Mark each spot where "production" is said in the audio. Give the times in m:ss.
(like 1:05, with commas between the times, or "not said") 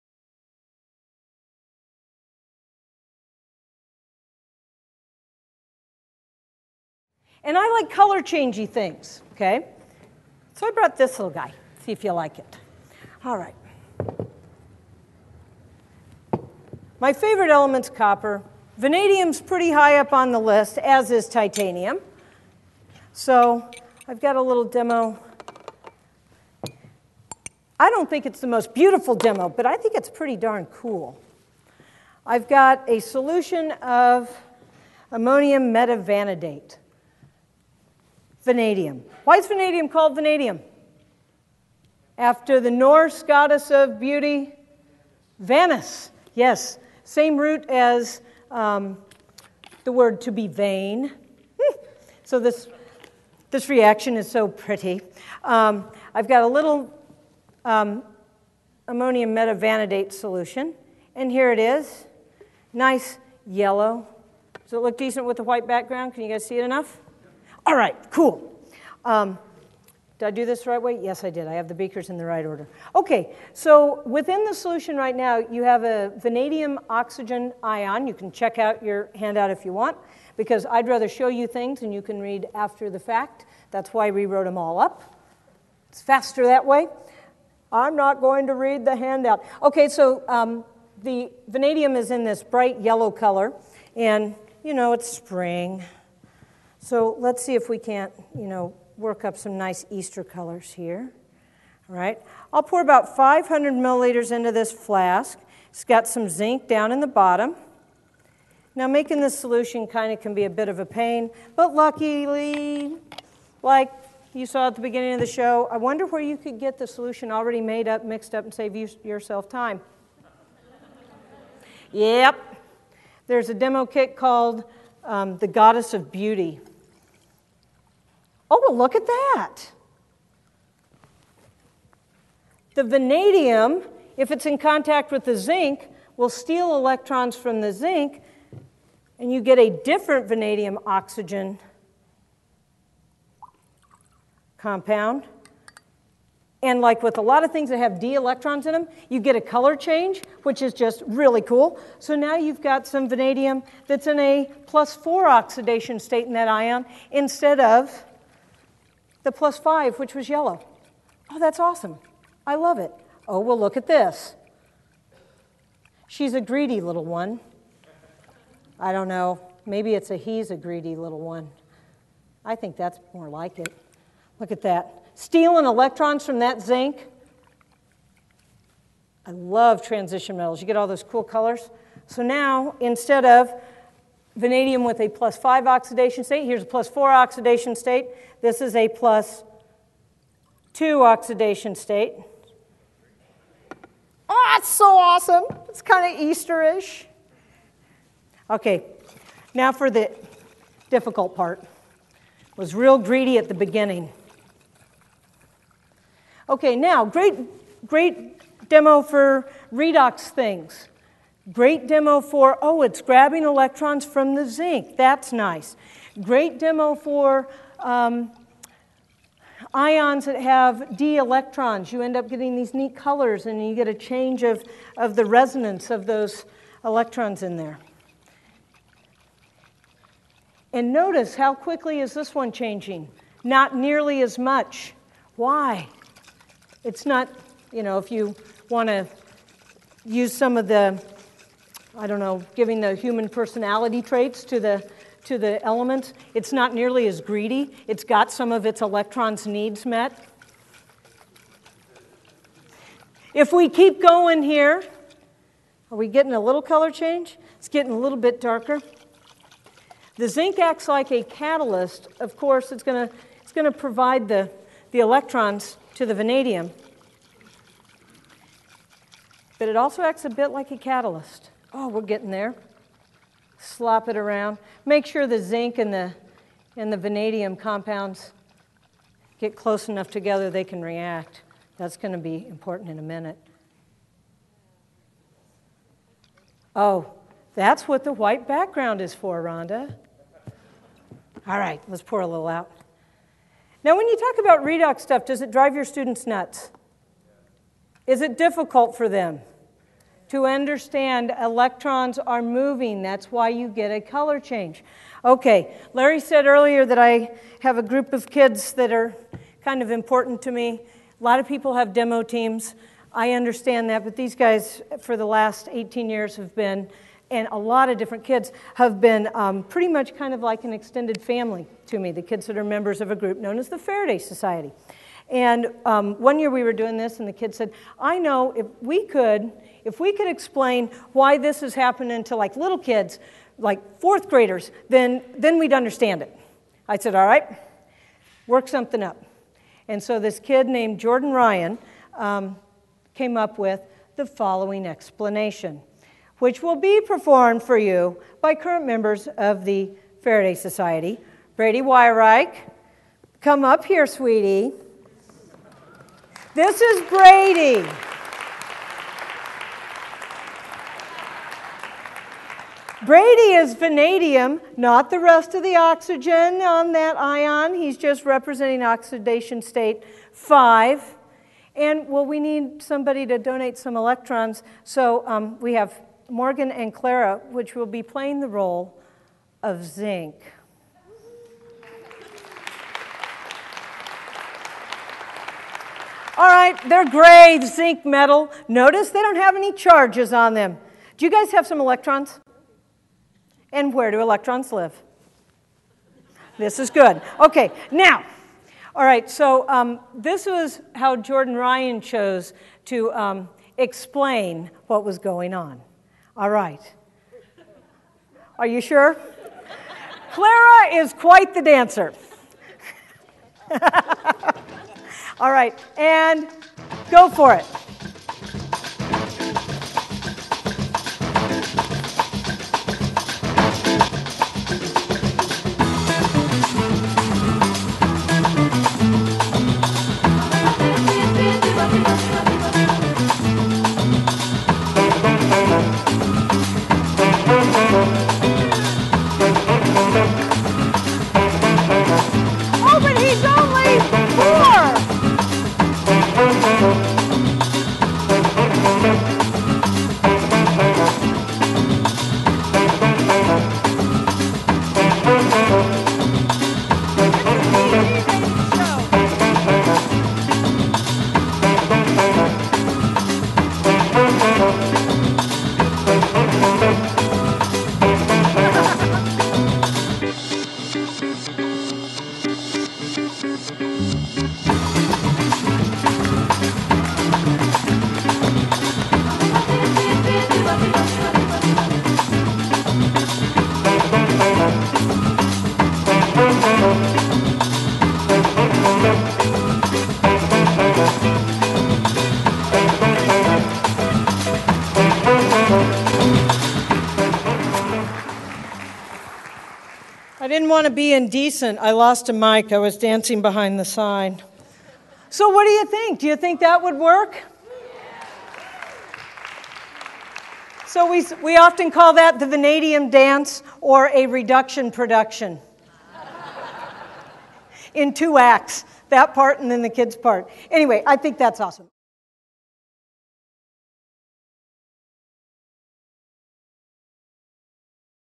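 8:34.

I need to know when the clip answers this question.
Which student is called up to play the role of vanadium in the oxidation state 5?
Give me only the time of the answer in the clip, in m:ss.
5:51.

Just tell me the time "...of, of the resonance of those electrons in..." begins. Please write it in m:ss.
3:44.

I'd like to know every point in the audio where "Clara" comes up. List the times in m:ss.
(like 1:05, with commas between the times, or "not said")
6:16, 6:50.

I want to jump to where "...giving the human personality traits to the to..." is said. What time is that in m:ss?
4:02.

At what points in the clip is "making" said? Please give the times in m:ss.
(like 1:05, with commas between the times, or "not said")
1:48.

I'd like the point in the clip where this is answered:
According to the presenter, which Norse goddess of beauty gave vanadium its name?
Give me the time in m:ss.
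0:45.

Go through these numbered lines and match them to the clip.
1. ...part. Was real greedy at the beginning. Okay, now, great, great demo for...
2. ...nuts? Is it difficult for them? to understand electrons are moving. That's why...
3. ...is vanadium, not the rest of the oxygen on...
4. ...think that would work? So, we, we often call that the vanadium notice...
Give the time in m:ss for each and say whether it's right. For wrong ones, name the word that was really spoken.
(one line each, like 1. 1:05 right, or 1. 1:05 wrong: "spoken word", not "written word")
1. 3:21 right
2. 4:56 right
3. 6:03 right
4. 8:26 wrong: "dance", not "notice".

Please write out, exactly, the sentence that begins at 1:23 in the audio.
That's why we wrote them all up.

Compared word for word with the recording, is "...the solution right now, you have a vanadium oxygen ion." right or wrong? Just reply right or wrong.
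right.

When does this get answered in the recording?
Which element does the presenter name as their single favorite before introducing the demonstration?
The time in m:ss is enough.
0:17.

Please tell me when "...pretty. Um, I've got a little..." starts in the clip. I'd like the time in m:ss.
0:54.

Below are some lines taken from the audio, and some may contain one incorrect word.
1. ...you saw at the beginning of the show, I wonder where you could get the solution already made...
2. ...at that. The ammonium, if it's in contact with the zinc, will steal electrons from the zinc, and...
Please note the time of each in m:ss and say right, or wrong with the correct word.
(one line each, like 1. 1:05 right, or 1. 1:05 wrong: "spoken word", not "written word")
1. 1:54 right
2. 2:08 wrong: "vanadium", not "ammonium".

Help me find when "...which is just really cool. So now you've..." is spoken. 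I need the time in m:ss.
2:30.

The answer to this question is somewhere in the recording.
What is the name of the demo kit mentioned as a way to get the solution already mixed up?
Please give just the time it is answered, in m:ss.
2:05.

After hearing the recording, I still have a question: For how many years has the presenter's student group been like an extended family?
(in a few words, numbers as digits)
18 years.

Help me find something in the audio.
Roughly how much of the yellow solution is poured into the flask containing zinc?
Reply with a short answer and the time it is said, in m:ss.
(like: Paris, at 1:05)
500 milliliters, at 1:43.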